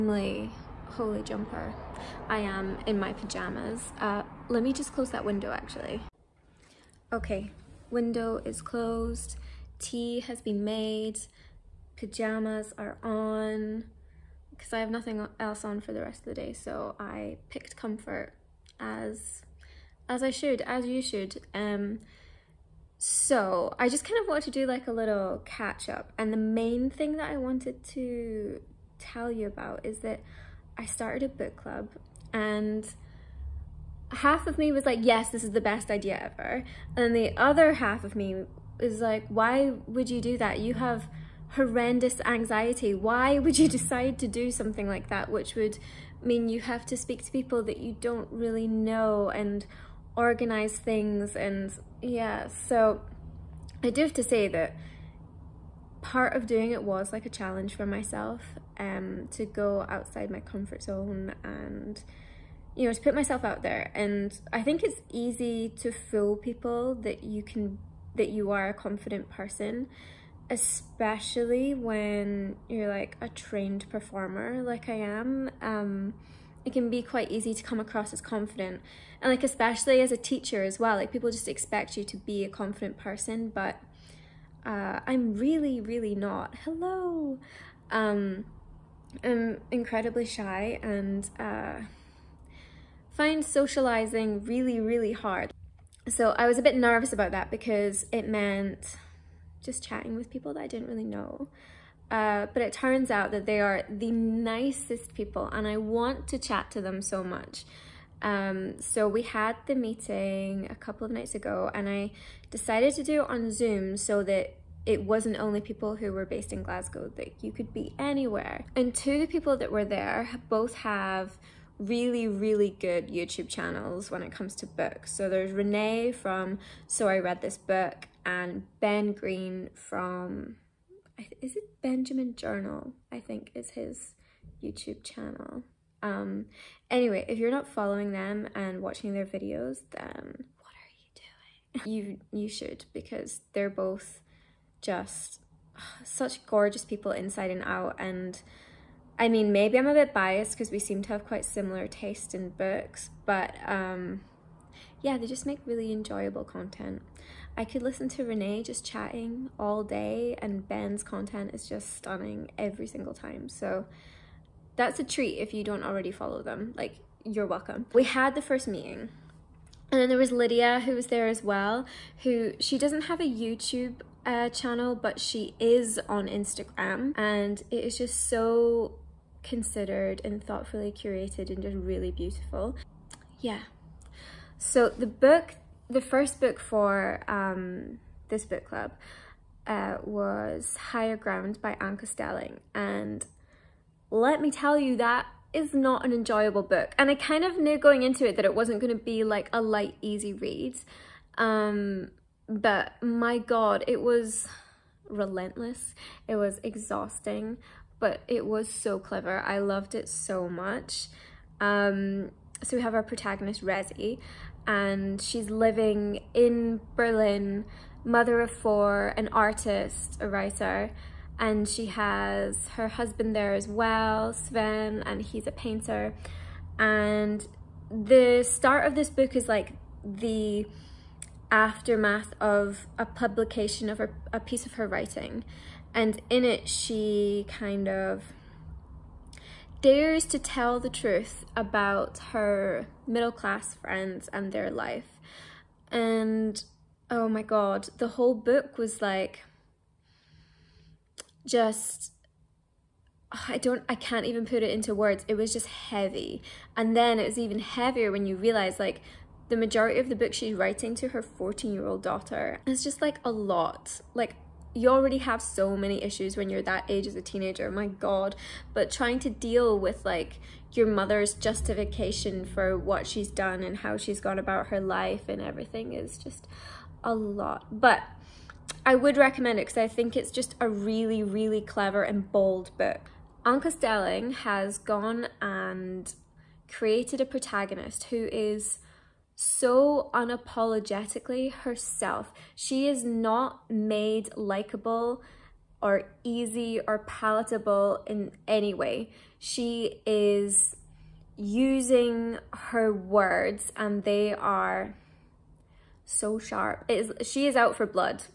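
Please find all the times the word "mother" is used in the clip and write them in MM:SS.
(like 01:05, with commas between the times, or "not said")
03:38, 04:30.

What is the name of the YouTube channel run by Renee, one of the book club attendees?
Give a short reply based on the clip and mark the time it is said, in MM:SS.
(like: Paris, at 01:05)
So I Read This Book, at 02:06.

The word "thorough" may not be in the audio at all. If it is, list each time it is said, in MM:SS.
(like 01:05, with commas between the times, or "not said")
not said.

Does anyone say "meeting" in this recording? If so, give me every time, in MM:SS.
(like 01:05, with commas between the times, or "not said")
01:49, 02:48.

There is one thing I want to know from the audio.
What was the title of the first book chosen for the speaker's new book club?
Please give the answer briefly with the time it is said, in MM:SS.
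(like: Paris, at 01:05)
Higher Ground, at 03:10.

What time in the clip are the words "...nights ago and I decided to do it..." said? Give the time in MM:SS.
01:51.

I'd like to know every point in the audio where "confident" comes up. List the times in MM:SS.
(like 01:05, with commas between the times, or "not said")
01:08, 01:18, 01:22.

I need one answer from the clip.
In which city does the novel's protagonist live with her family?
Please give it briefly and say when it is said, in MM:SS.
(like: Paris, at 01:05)
Berlin, at 03:36.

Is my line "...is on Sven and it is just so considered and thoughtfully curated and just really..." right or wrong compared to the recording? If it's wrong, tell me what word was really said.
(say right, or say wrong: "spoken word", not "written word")
wrong: "Instagram", not "Sven".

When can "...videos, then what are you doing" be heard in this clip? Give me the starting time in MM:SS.
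02:19.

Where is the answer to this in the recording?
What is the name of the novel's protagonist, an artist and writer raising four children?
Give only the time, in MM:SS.
03:33.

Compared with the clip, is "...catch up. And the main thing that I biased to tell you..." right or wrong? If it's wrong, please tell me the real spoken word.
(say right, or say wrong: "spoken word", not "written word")
wrong: "wanted", not "biased".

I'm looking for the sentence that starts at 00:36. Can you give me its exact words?
And the other half of me is like, why would you do that?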